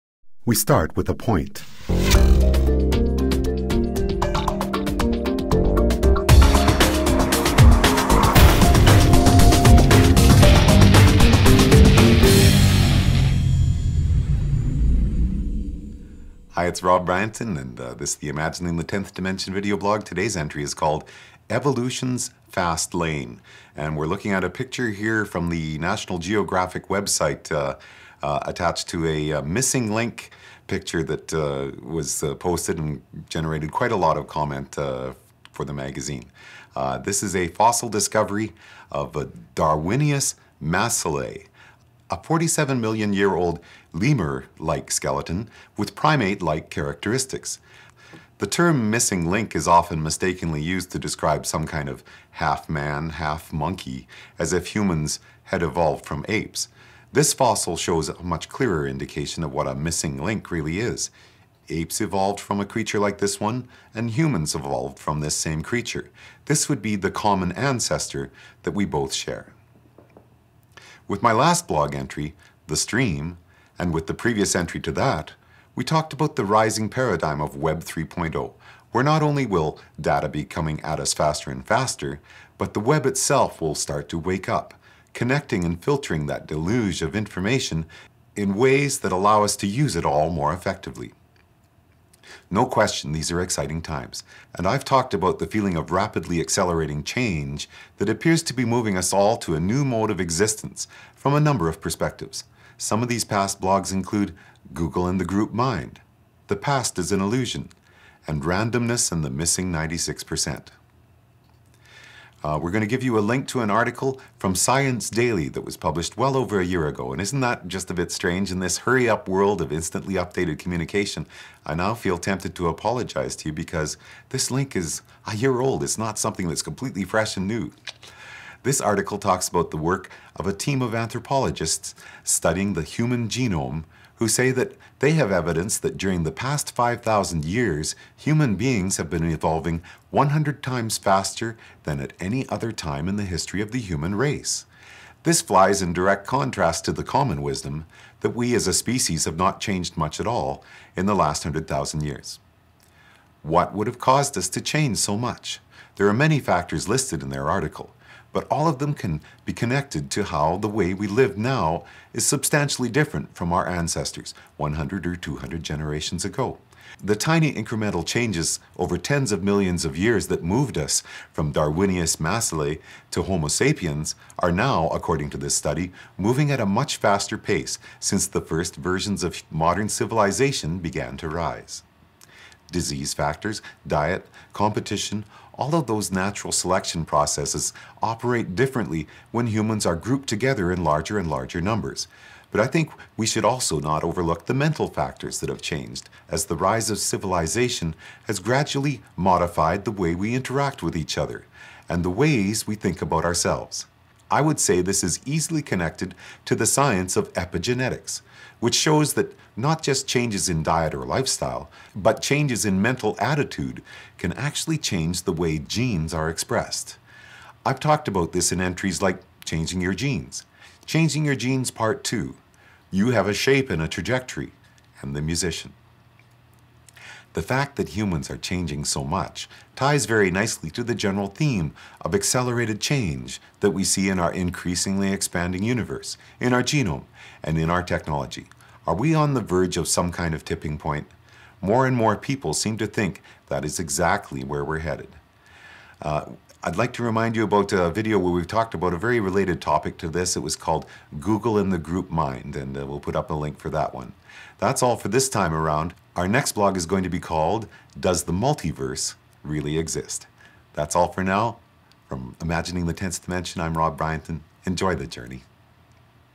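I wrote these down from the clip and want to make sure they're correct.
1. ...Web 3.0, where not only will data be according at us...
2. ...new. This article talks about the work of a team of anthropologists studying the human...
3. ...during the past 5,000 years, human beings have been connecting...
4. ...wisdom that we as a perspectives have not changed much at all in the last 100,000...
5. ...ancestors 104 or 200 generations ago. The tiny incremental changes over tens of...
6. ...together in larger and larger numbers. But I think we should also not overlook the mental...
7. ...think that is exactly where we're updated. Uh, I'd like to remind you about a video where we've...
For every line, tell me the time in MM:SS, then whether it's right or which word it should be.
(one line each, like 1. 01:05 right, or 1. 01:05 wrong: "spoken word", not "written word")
1. 01:17 wrong: "coming", not "according"
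2. 02:07 right
3. 02:15 wrong: "evolving", not "connecting"
4. 02:27 wrong: "species", not "perspectives"
5. 02:43 wrong: "100", not "104"
6. 03:10 right
7. 04:02 wrong: "headed", not "updated".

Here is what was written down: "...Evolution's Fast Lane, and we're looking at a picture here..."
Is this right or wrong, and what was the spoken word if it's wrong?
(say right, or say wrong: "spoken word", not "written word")
right.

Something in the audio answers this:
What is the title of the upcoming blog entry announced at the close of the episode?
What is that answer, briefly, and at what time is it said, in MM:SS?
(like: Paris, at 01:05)
Does the Multiverse Really Exist?, at 04:17.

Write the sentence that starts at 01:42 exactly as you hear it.
Some of these past blogs include Google and the group mind, The Past is an Illusion, and Randomness and the Missing 96%.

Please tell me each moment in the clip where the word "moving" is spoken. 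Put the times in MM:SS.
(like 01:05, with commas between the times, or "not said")
01:38, 02:56.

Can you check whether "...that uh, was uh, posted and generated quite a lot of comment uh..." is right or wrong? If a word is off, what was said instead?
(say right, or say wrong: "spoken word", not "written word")
right.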